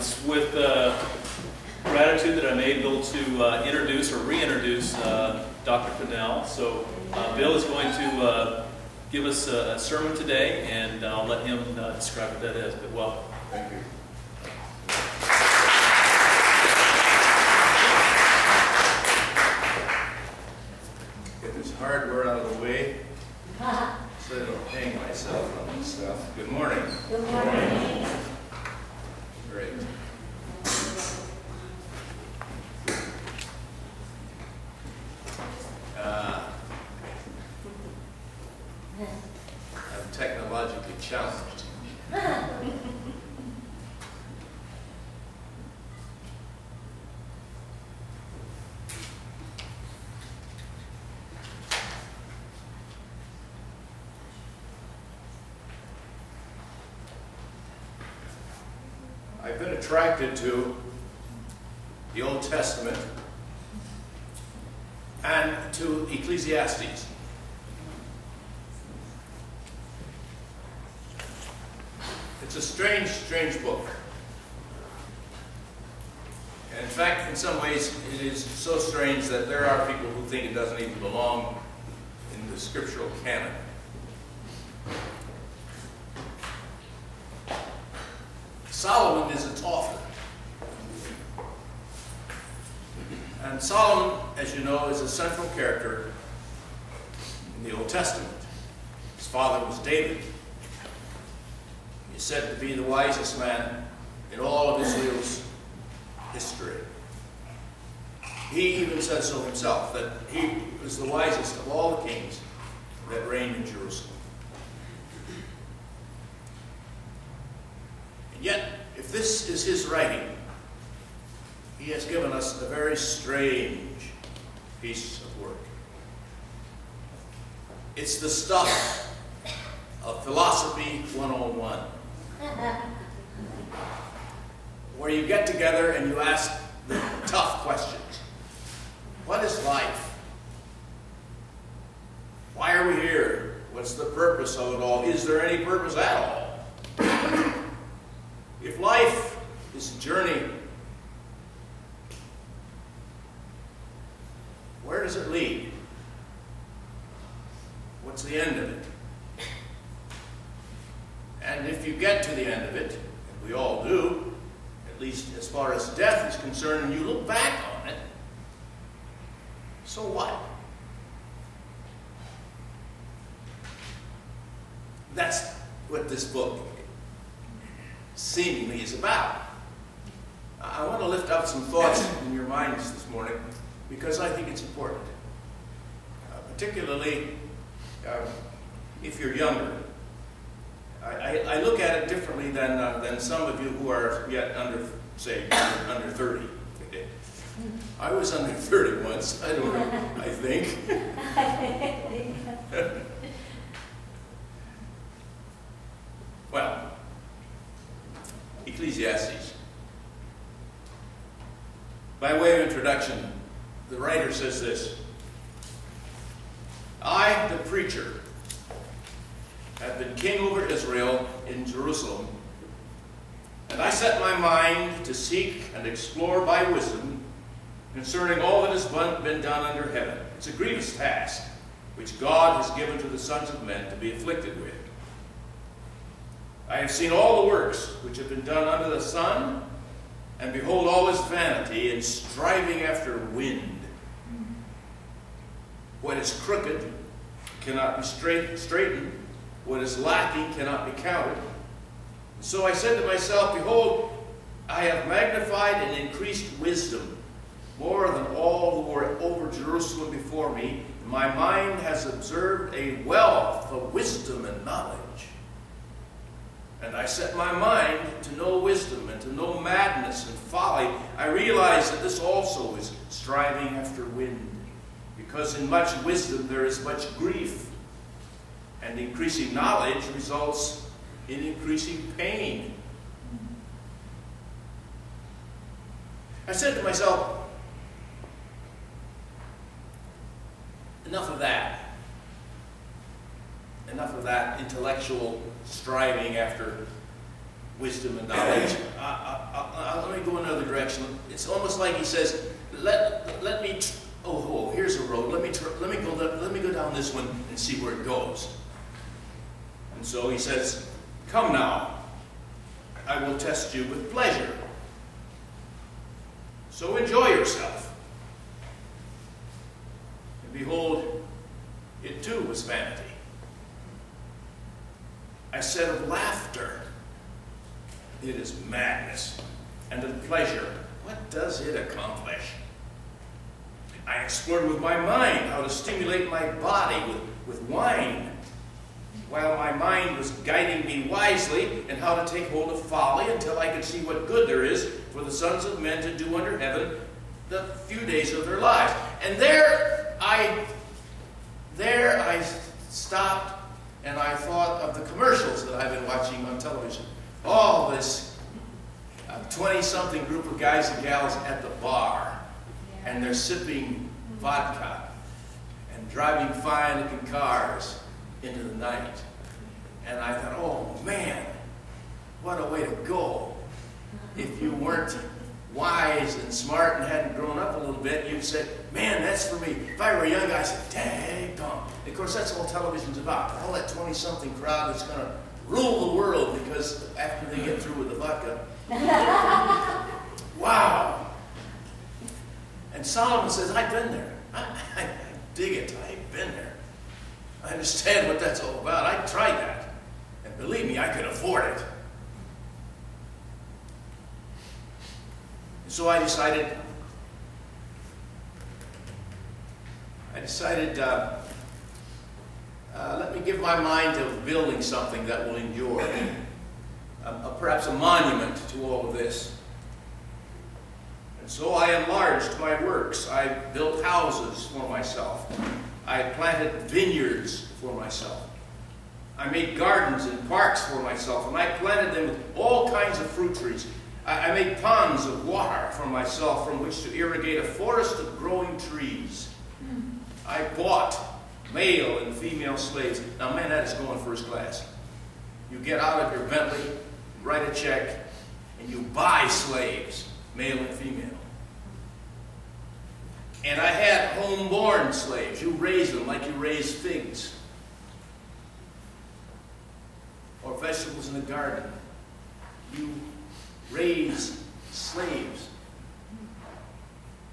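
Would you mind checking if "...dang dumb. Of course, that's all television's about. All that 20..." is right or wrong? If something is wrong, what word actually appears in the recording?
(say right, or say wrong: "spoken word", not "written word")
right.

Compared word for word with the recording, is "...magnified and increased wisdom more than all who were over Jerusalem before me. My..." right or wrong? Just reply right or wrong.
right.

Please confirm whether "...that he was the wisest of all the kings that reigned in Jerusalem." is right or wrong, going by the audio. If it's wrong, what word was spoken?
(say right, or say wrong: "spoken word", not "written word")
right.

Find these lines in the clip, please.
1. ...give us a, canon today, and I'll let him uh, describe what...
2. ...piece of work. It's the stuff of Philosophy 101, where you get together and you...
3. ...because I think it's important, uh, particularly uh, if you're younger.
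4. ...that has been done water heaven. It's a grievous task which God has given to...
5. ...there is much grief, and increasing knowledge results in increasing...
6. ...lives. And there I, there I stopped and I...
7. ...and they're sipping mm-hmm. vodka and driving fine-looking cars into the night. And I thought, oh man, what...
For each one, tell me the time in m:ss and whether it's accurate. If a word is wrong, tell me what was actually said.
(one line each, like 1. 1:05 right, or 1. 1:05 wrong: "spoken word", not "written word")
1. 0:09 wrong: "sermon", not "canon"
2. 2:04 right
3. 3:03 right
4. 3:48 wrong: "under", not "water"
5. 4:36 right
6. 5:48 right
7. 6:03 right.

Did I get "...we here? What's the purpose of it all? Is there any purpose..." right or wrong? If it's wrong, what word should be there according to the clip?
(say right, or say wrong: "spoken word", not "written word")
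right.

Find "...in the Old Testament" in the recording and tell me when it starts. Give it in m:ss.
1:37.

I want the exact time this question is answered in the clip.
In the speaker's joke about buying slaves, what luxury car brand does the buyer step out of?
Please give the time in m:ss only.
7:26.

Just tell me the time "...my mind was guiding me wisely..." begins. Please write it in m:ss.
5:39.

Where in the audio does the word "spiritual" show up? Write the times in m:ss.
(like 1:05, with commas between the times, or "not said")
not said.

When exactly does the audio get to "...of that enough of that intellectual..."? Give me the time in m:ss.
4:51.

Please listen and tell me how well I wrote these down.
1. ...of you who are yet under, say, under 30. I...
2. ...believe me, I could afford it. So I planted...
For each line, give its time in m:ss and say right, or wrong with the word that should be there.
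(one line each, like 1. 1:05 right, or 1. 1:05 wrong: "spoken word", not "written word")
1. 3:13 right
2. 6:40 wrong: "decided", not "planted".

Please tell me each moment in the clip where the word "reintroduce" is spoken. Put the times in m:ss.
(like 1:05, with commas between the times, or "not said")
0:04.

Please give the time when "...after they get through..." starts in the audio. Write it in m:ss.
6:27.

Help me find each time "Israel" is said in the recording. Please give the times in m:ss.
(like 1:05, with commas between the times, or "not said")
1:44, 3:40.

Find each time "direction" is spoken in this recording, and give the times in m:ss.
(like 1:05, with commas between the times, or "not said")
5:00.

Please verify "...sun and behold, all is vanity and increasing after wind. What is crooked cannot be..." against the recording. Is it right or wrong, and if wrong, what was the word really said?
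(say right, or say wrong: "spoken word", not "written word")
wrong: "striving", not "increasing".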